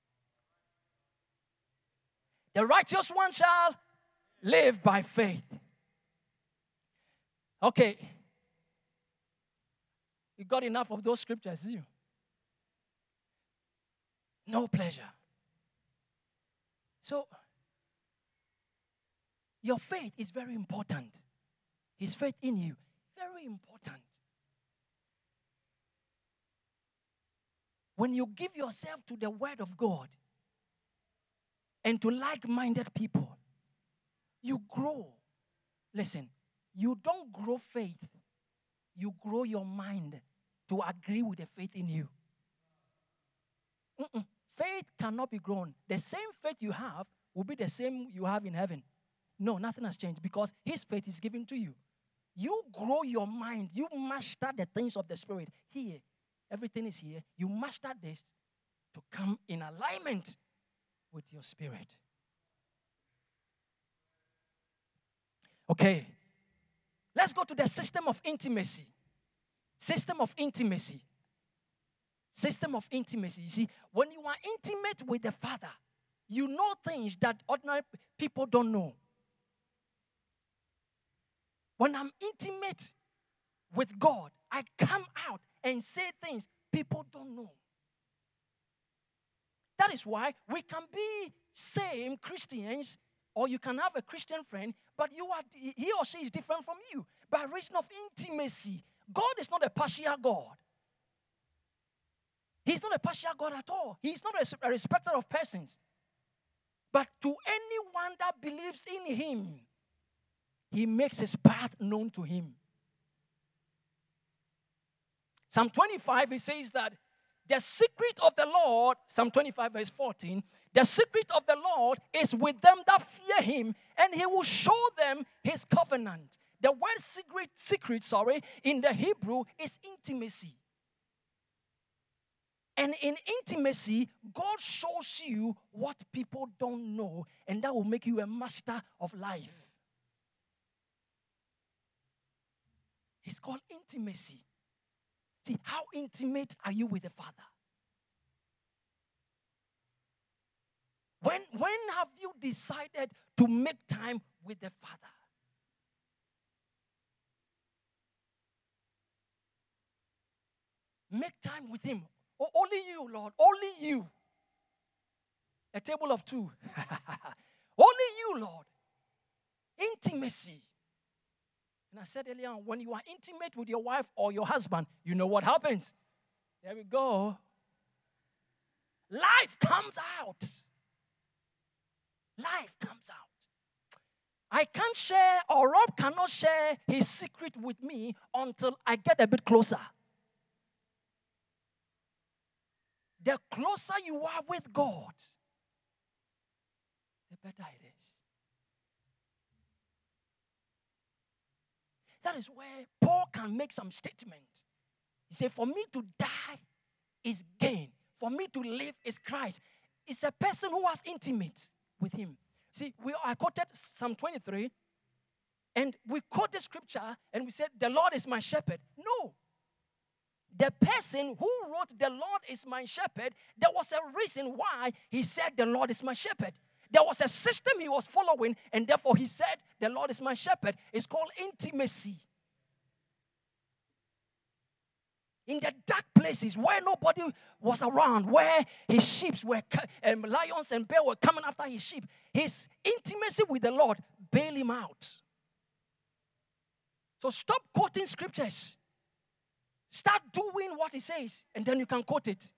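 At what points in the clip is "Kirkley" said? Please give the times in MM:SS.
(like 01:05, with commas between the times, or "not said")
not said.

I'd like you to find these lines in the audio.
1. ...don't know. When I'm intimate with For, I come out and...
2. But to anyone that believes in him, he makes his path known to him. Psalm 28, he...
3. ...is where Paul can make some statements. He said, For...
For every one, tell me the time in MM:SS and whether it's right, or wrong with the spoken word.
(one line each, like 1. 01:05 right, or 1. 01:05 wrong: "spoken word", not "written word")
1. 01:18 wrong: "God", not "For"
2. 01:46 wrong: "25", not "28"
3. 03:22 right.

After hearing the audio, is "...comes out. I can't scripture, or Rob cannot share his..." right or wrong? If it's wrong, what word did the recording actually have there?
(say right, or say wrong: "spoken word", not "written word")
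wrong: "share", not "scripture".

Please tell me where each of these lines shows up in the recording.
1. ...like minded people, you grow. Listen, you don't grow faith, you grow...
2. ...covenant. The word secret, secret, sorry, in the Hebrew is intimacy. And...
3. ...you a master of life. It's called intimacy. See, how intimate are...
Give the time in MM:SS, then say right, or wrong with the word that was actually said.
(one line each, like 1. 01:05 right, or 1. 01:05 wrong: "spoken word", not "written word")
1. 00:32 right
2. 02:05 right
3. 02:18 right.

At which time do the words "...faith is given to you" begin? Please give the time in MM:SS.
00:50.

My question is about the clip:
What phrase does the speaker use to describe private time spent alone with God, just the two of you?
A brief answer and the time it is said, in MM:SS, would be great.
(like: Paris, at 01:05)
A table of two, at 02:45.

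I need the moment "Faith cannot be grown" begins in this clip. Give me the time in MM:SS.
00:44.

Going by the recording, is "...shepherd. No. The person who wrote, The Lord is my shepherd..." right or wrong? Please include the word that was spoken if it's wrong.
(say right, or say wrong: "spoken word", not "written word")
right.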